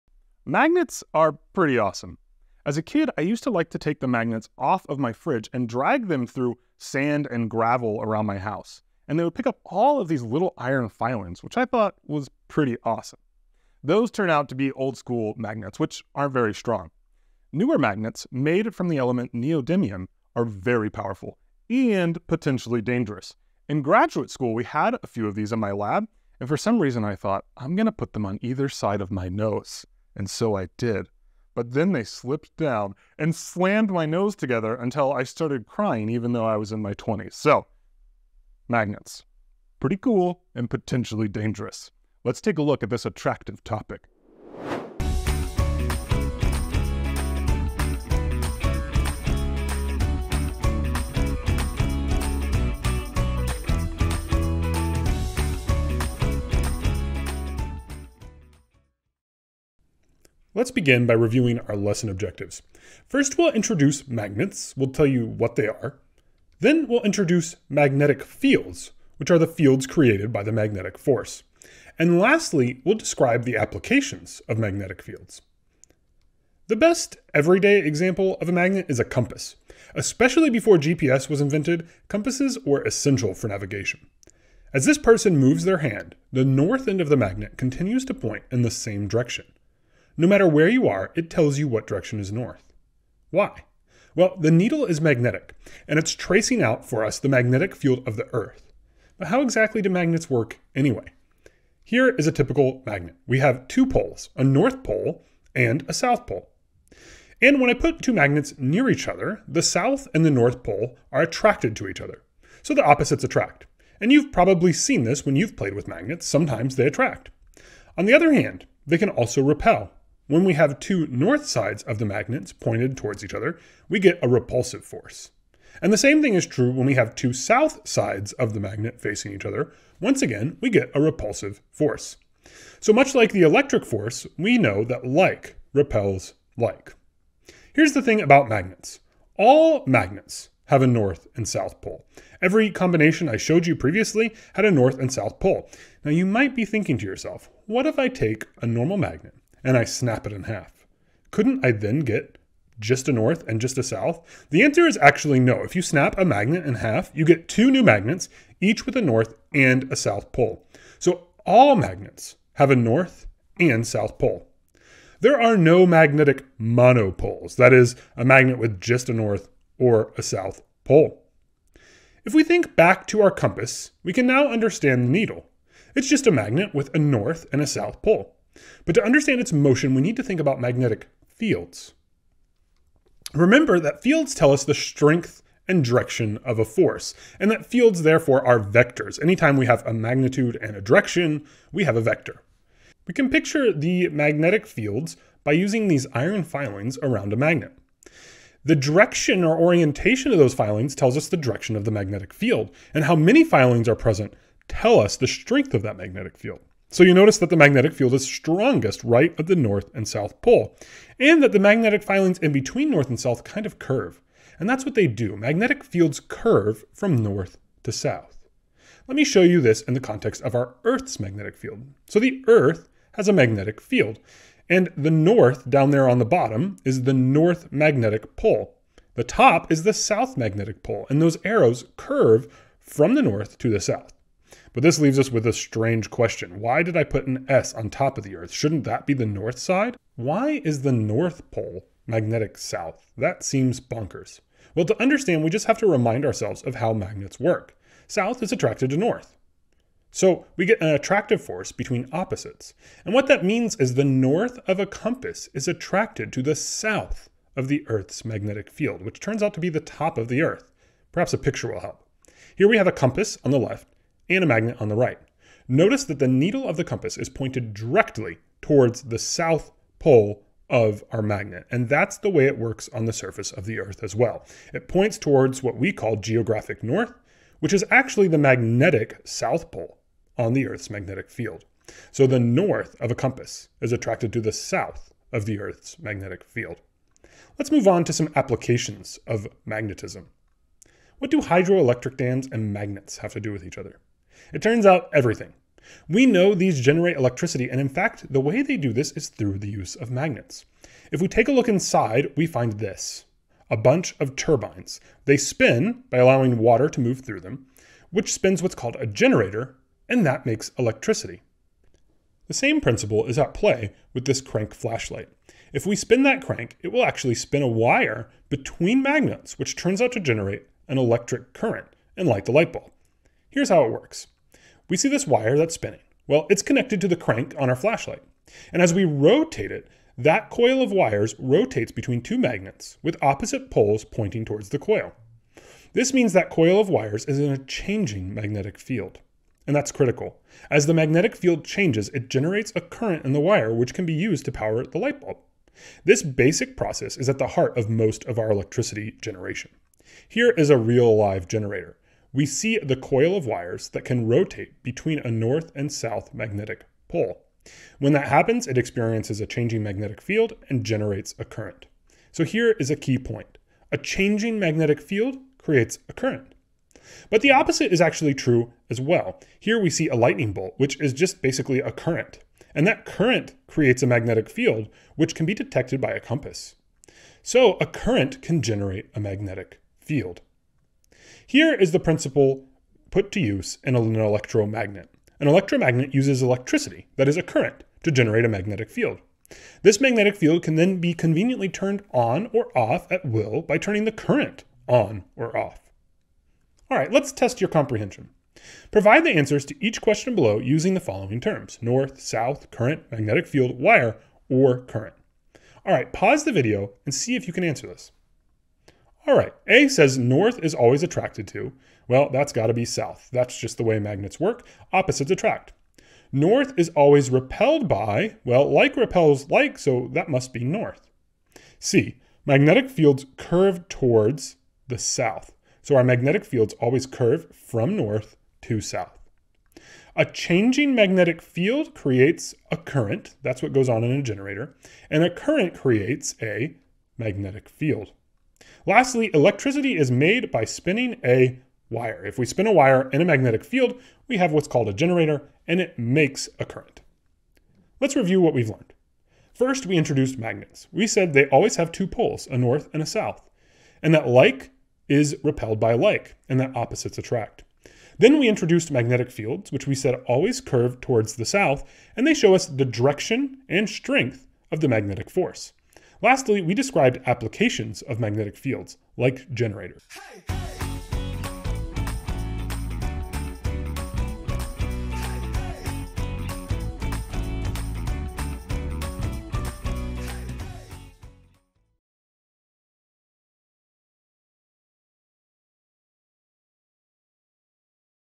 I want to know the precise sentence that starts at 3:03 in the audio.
Remember that fields tell us the strength and direction of a force, and that fields therefore are vectors.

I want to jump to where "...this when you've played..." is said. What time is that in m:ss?
1:55.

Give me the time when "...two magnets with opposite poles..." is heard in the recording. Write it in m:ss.
5:32.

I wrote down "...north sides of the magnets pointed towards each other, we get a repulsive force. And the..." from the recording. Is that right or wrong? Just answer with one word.
right.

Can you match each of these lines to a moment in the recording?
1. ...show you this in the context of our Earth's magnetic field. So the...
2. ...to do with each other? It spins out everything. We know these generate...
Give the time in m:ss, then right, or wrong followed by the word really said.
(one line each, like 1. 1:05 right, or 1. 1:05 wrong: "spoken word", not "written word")
1. 3:39 right
2. 4:53 wrong: "turns", not "spins".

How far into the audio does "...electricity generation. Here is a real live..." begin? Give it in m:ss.
5:48.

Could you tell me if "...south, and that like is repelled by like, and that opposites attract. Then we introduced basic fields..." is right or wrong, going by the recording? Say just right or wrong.
wrong.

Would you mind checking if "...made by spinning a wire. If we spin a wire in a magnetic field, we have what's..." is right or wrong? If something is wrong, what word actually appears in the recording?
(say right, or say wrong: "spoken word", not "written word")
right.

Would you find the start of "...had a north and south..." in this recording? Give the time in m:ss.
2:24.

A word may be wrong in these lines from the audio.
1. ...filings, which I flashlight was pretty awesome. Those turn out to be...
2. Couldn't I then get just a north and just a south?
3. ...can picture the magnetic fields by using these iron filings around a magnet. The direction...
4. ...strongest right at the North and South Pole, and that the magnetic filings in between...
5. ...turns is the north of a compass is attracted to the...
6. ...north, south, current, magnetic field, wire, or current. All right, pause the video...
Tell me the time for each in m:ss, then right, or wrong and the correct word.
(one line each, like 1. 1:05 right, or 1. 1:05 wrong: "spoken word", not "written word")
1. 0:10 wrong: "thought", not "flashlight"
2. 2:31 right
3. 3:13 right
4. 3:28 right
5. 4:13 wrong: "means", not "turns"
6. 6:41 right.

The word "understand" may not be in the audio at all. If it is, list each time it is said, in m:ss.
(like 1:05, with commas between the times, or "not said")
2:54, 2:59, 4:05.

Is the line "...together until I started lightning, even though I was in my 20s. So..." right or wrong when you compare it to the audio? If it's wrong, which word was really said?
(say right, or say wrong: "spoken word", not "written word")
wrong: "crying", not "lightning".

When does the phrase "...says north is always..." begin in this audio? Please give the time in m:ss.
6:49.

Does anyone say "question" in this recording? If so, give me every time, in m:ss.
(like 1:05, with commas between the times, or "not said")
3:56, 6:40.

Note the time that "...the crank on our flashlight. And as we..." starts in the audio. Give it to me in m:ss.
5:27.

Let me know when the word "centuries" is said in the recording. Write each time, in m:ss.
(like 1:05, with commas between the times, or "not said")
not said.